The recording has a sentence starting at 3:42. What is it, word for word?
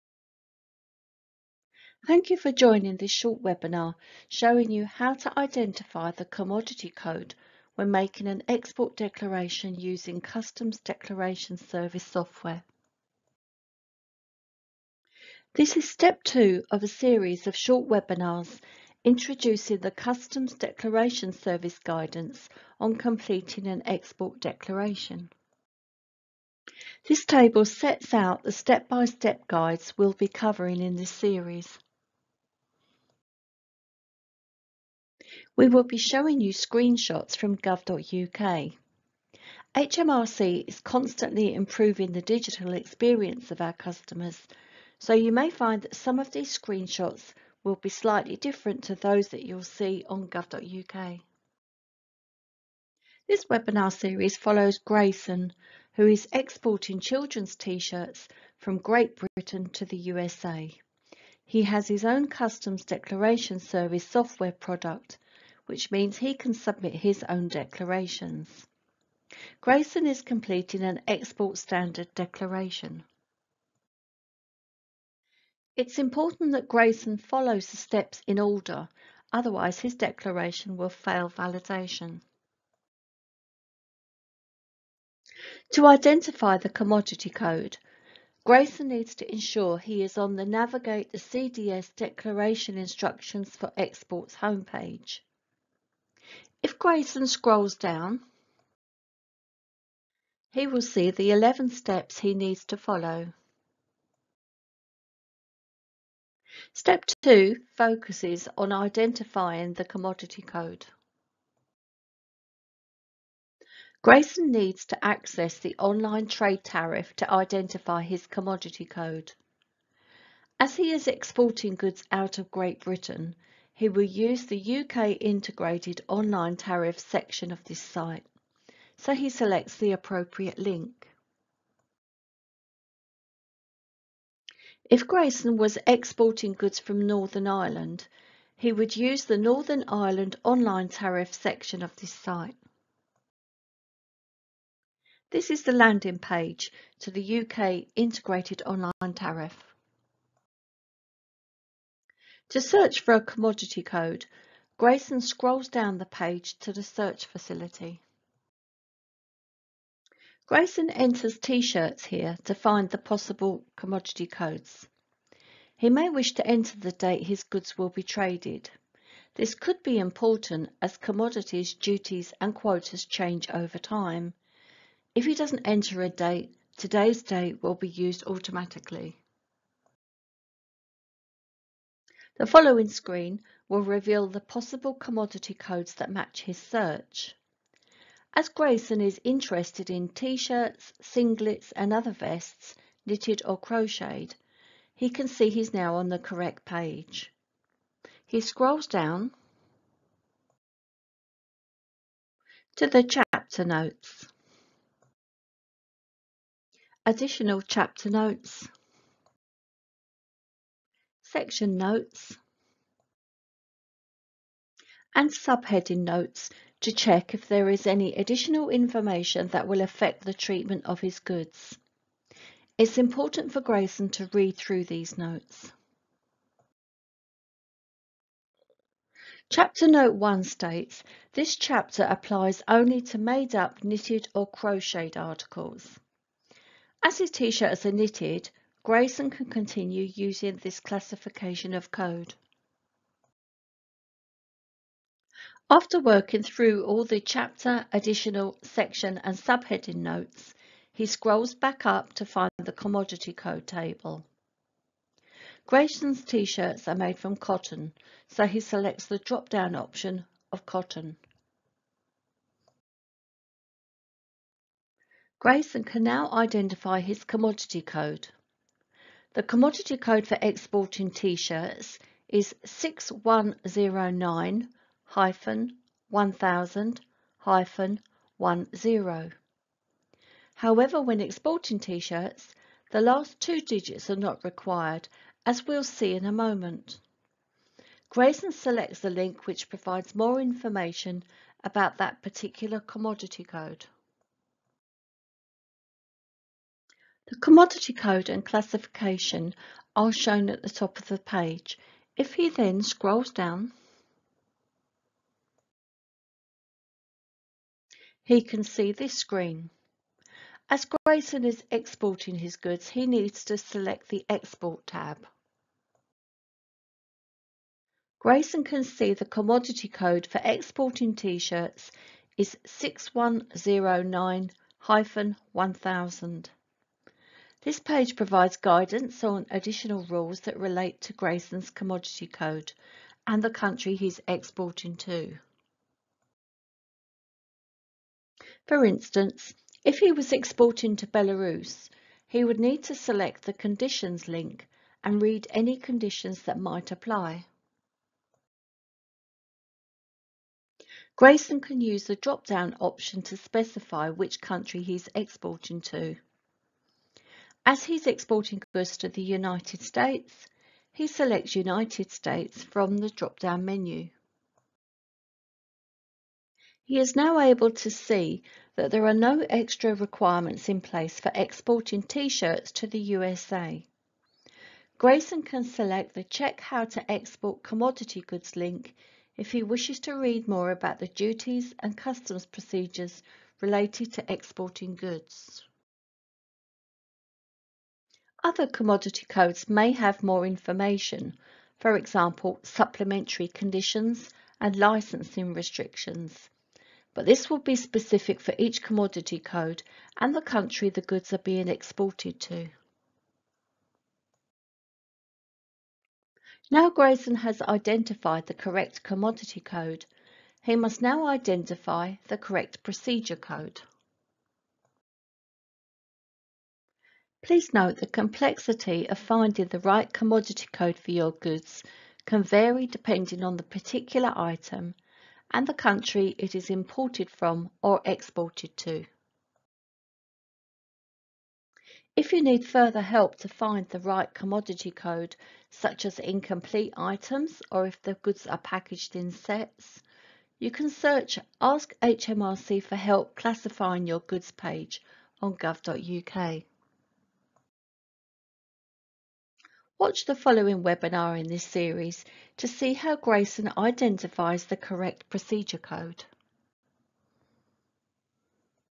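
It's important for Grayson to read through these notes.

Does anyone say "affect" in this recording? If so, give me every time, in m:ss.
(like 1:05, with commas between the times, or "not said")
3:39.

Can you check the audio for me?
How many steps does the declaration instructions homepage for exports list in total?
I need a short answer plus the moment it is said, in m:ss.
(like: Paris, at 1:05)
11, at 1:41.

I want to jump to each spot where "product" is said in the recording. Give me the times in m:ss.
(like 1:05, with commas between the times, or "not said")
1:04.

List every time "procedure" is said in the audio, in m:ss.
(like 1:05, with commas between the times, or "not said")
6:22, 6:52, 7:35.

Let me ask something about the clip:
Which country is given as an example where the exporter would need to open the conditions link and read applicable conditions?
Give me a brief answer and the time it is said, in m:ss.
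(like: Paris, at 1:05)
Belarus, at 5:41.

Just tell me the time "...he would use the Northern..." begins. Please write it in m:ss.
2:18.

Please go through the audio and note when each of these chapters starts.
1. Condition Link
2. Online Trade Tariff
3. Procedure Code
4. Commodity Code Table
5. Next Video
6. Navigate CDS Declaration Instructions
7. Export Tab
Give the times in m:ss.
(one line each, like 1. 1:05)
1. 5:38
2. 1:53
3. 6:49
4. 4:08
5. 7:29
6. 1:25
7. 5:07.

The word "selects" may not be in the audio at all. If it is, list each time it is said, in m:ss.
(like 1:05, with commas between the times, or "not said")
2:09, 4:18, 4:48, 5:13, 5:42, 6:01, 6:15.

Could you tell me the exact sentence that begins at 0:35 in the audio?
We will be showing you screenshots from gov.uk.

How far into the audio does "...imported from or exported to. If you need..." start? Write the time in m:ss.
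7:06.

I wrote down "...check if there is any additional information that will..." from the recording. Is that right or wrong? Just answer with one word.
right.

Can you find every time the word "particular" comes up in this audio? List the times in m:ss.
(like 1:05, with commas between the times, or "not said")
4:52, 7:03.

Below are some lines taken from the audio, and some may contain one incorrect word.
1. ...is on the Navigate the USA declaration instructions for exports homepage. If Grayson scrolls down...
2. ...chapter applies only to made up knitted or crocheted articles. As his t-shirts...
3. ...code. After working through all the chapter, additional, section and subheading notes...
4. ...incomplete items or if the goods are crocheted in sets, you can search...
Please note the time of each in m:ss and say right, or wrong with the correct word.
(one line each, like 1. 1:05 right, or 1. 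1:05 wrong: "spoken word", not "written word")
1. 1:30 wrong: "CDS", not "USA"
2. 3:51 right
3. 4:01 right
4. 7:16 wrong: "packaged", not "crocheted".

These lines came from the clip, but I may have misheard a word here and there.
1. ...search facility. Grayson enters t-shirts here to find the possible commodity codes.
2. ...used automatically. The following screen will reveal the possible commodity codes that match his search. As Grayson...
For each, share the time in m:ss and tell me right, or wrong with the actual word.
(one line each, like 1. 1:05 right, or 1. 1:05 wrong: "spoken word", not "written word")
1. 2:36 right
2. 2:57 right.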